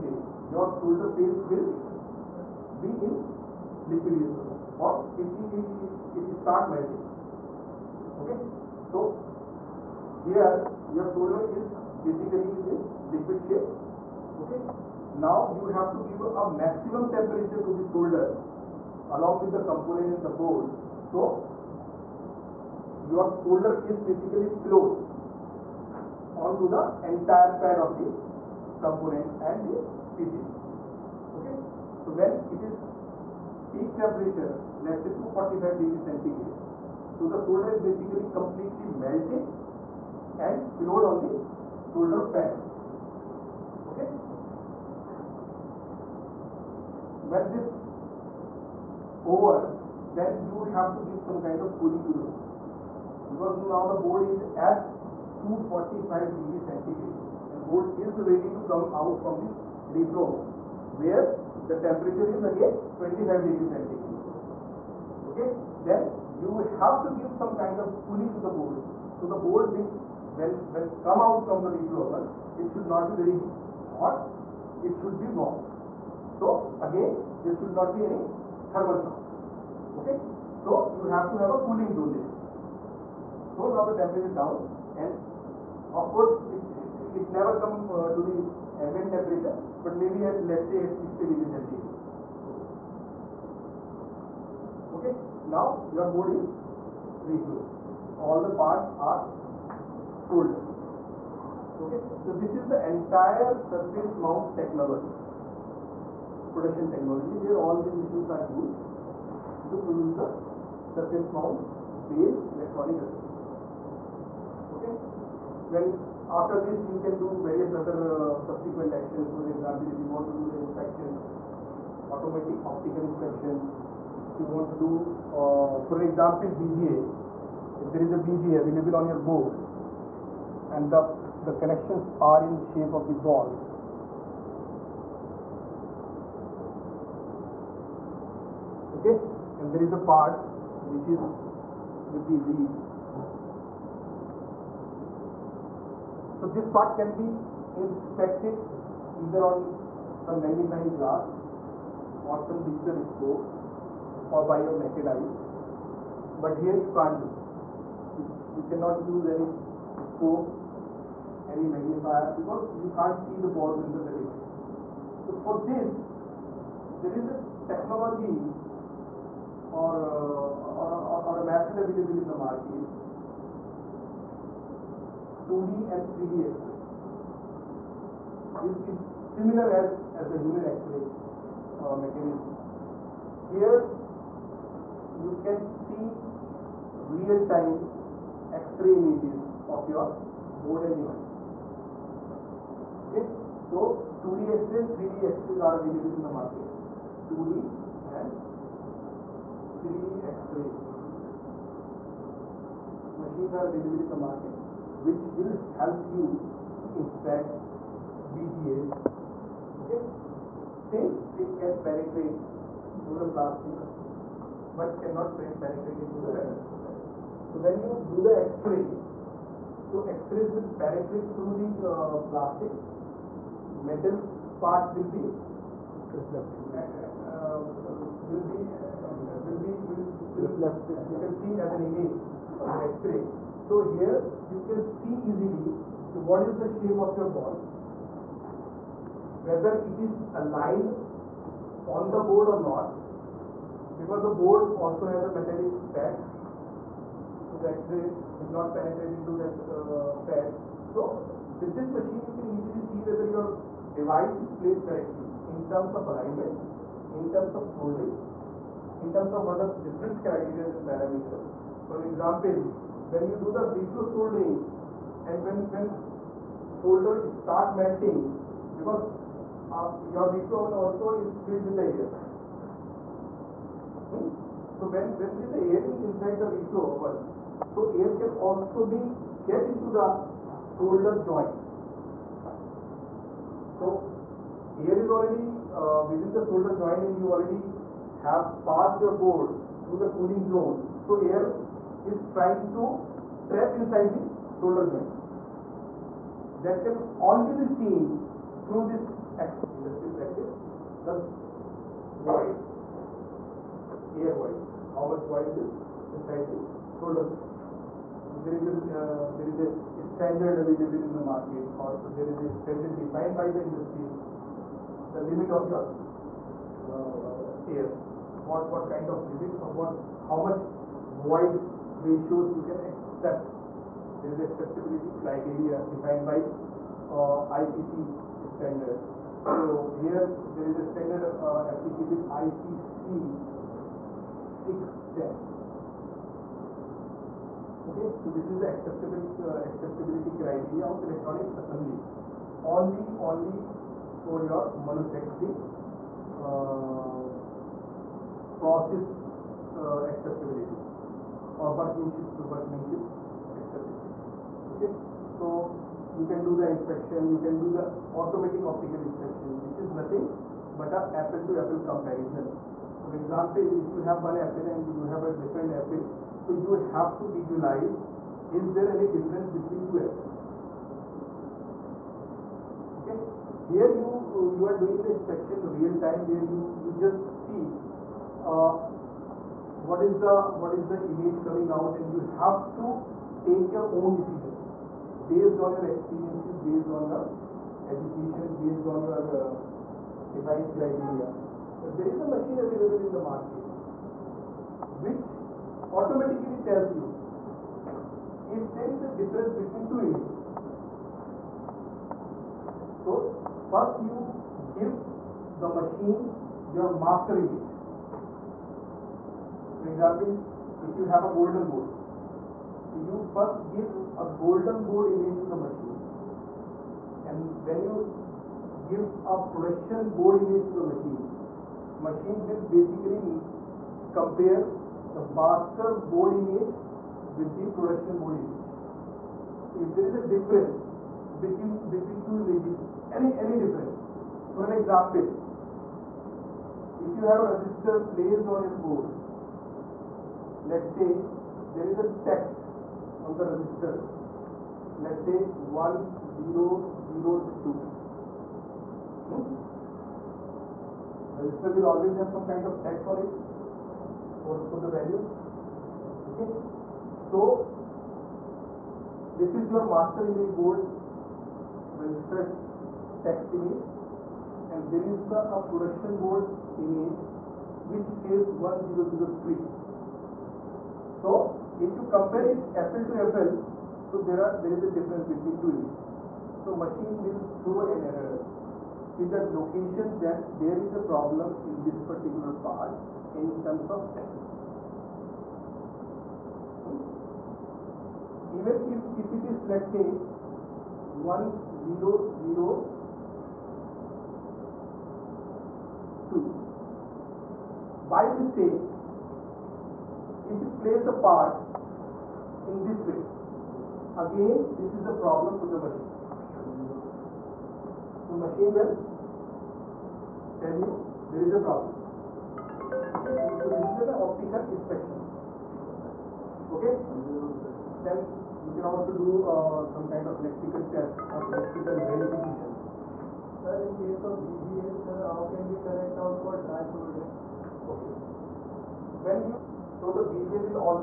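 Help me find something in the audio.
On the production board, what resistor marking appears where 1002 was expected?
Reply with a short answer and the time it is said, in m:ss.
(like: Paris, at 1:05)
1003, at 7:48.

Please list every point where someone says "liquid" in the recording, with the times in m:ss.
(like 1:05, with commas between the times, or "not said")
0:03, 0:13.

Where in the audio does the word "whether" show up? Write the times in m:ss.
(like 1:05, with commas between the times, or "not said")
3:59, 4:13.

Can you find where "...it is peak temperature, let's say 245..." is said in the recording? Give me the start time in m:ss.
0:32.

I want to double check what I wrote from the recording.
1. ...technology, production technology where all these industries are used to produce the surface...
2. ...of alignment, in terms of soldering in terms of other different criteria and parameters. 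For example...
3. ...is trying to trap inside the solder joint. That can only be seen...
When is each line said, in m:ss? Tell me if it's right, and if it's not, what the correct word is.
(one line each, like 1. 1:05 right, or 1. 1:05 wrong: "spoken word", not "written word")
1. 1:44 wrong: "machines", not "industries"
2. 4:15 right
3. 4:52 right.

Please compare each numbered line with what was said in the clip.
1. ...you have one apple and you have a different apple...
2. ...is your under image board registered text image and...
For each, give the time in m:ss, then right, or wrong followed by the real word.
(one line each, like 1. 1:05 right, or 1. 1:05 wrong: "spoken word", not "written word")
1. 6:03 right
2. 7:39 wrong: "master", not "under".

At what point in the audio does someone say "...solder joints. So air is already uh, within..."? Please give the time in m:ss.
4:40.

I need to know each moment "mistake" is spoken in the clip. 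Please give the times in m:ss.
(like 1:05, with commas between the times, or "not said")
8:18.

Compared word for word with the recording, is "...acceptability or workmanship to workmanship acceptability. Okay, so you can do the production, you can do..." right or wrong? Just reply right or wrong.
wrong.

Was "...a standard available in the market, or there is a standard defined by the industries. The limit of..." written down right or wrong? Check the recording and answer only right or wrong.
right.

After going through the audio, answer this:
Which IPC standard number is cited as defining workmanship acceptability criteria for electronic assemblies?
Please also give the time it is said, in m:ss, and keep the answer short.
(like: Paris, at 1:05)
IPC 610, at 5:32.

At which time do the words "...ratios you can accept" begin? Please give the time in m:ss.
5:22.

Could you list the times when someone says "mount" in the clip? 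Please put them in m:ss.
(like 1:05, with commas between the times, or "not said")
1:44, 1:51.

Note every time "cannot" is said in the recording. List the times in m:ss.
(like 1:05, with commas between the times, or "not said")
2:38, 3:35.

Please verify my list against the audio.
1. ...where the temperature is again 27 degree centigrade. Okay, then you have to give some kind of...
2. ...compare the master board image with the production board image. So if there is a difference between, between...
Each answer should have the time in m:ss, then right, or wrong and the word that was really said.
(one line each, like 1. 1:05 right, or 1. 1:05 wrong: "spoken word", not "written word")
1. 1:01 wrong: "25", not "27"
2. 7:04 right.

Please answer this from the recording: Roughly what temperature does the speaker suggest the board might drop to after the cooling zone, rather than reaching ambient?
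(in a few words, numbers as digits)
60 degrees centigrade.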